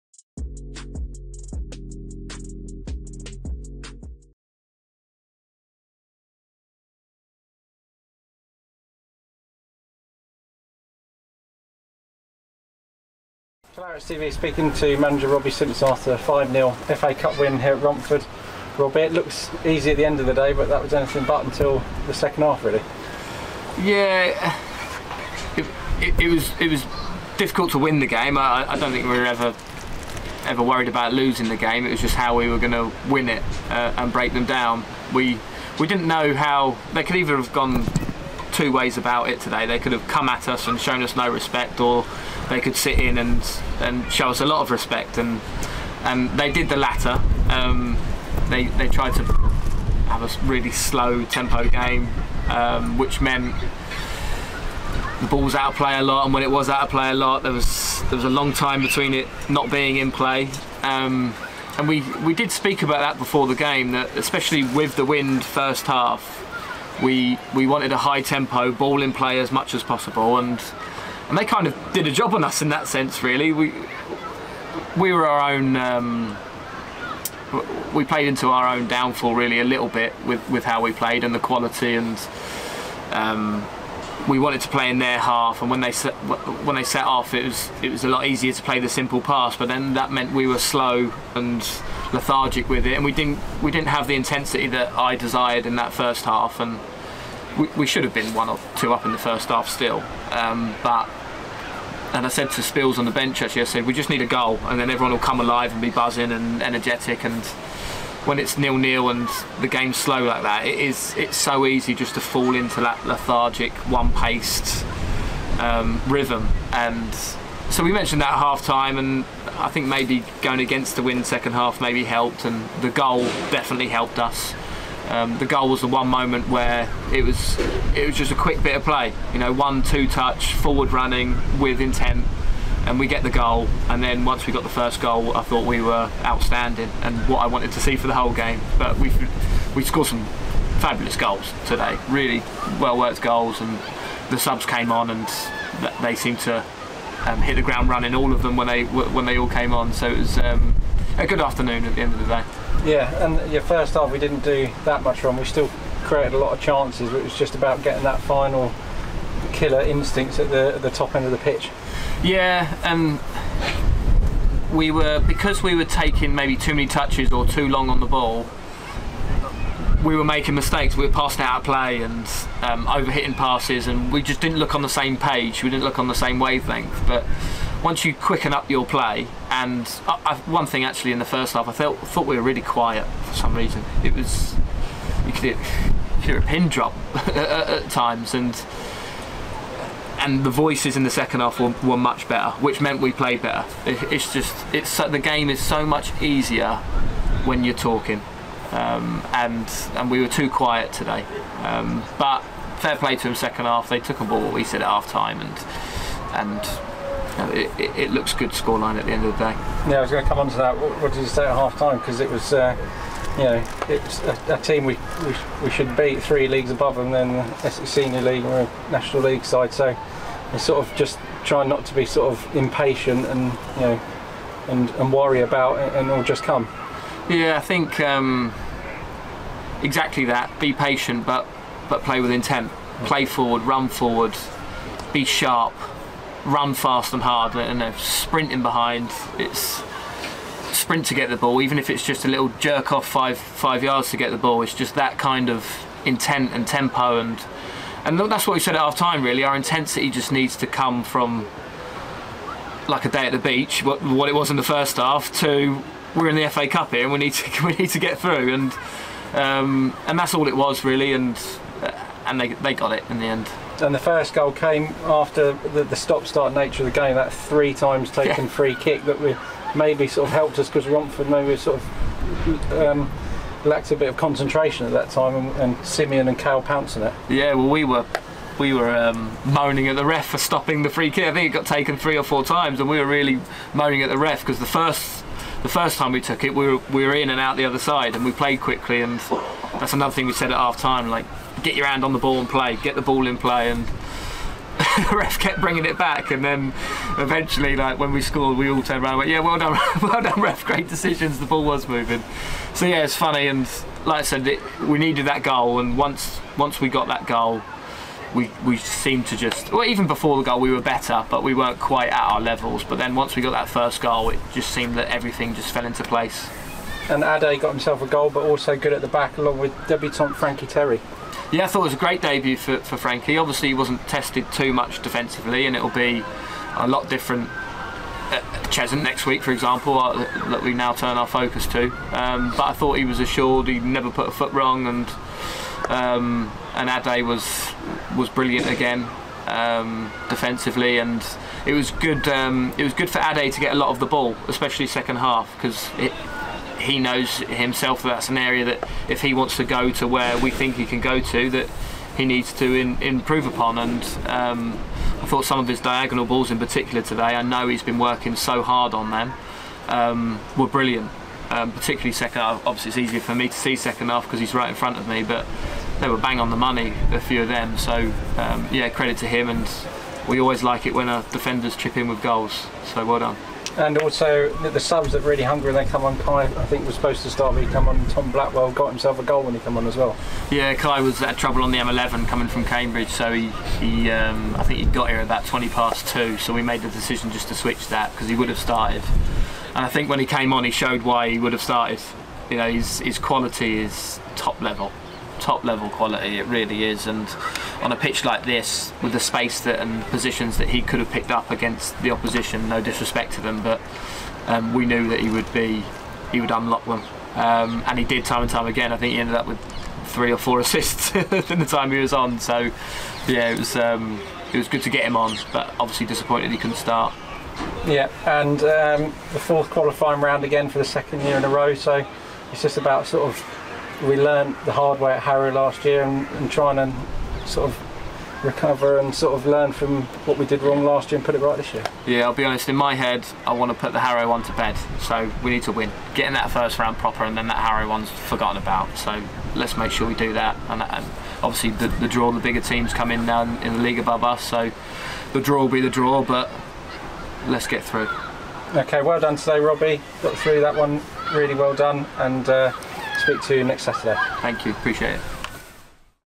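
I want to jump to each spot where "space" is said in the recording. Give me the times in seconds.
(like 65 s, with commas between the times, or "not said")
399 s.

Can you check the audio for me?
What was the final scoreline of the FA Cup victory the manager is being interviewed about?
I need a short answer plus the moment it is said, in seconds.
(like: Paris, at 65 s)
5-0, at 16 s.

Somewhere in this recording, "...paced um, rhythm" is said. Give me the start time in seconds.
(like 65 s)
114 s.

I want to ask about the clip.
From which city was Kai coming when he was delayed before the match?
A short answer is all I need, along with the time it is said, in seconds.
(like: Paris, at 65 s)
Cambridge, at 382 s.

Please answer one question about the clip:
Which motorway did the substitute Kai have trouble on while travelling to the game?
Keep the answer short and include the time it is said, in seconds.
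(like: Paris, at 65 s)
M11, at 381 s.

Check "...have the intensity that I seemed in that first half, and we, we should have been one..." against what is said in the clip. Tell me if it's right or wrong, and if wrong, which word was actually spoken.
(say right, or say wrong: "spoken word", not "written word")
wrong: "desired", not "seemed".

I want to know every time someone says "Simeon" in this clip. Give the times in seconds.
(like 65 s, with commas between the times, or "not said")
275 s.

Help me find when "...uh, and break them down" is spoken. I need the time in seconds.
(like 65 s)
33 s.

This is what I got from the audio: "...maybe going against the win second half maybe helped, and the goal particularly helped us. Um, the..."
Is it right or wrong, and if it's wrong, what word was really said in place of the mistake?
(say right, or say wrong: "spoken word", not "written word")
wrong: "definitely", not "particularly".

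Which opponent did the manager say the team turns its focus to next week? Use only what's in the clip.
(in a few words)
Cheshunt.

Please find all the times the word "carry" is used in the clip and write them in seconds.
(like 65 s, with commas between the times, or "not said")
not said.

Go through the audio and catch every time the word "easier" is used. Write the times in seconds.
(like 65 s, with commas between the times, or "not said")
88 s, 196 s, 363 s.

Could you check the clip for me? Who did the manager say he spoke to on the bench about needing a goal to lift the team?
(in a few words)
Spills.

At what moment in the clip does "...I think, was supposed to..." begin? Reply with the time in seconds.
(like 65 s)
376 s.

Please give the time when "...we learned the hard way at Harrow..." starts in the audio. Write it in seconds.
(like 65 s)
424 s.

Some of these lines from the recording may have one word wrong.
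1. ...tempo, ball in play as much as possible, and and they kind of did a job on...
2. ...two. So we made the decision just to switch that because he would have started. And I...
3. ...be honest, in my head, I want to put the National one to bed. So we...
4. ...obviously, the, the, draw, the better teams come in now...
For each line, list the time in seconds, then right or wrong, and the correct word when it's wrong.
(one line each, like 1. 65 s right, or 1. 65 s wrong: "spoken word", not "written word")
1. 68 s right
2. 386 s right
3. 432 s wrong: "Harrow", not "National"
4. 441 s wrong: "bigger", not "better".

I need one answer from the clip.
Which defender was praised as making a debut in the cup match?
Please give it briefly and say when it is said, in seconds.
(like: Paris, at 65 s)
Frankie Terry, at 320 s.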